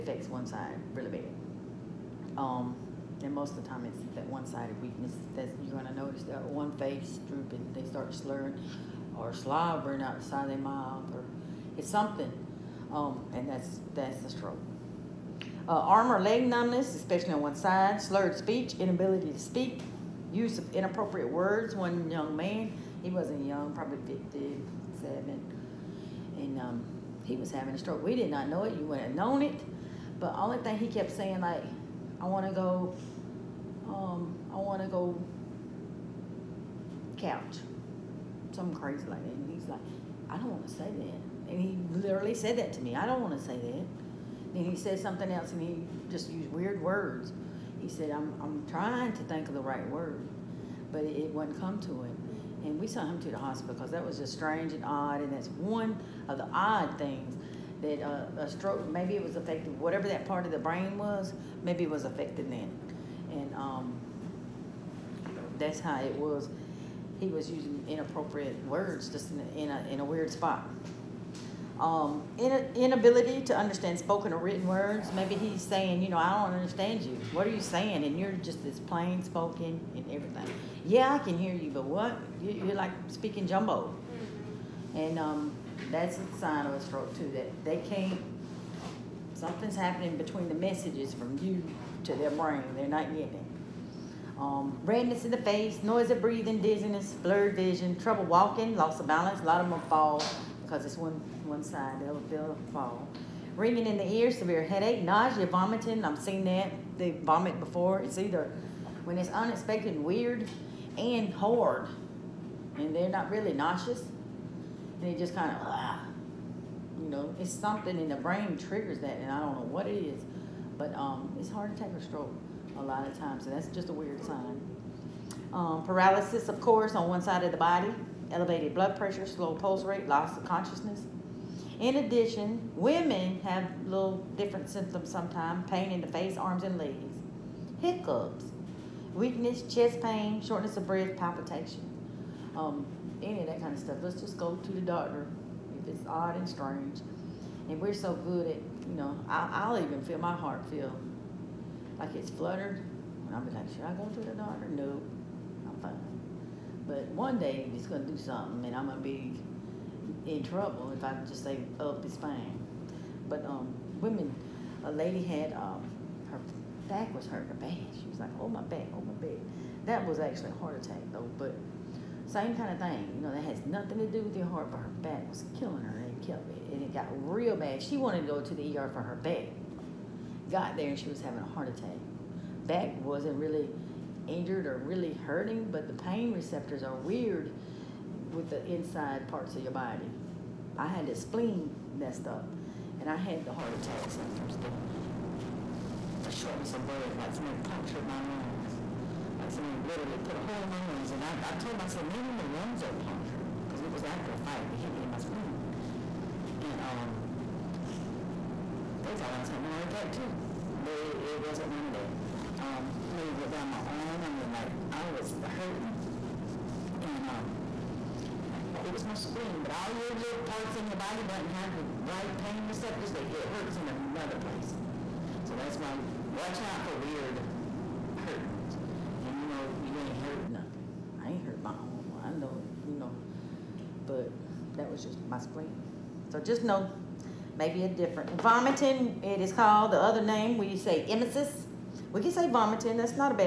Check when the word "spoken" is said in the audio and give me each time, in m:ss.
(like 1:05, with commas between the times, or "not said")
1:13, 1:19.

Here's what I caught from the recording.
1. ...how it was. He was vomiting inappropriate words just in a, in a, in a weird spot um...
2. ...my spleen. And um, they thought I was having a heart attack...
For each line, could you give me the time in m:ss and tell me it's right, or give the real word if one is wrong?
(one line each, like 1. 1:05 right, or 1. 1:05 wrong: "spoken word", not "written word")
1. 1:05 wrong: "using", not "vomiting"
2. 3:25 right.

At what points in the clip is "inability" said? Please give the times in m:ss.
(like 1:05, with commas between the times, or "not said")
0:18, 1:12.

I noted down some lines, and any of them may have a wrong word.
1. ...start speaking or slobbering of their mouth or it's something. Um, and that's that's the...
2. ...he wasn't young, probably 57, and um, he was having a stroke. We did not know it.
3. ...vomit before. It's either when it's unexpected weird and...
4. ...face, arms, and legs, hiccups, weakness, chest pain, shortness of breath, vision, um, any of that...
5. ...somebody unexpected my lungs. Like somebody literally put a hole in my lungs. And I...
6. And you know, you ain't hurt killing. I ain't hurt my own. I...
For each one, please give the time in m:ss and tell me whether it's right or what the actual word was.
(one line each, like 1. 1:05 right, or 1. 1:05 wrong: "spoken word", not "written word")
1. 0:07 wrong: "slurring", not "speaking"
2. 0:23 right
3. 1:47 right
4. 2:16 wrong: "palpitation", not "vision"
5. 3:17 wrong: "punctured", not "unexpected"
6. 3:49 wrong: "nothing", not "killing".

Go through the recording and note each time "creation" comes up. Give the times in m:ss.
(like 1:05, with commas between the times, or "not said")
not said.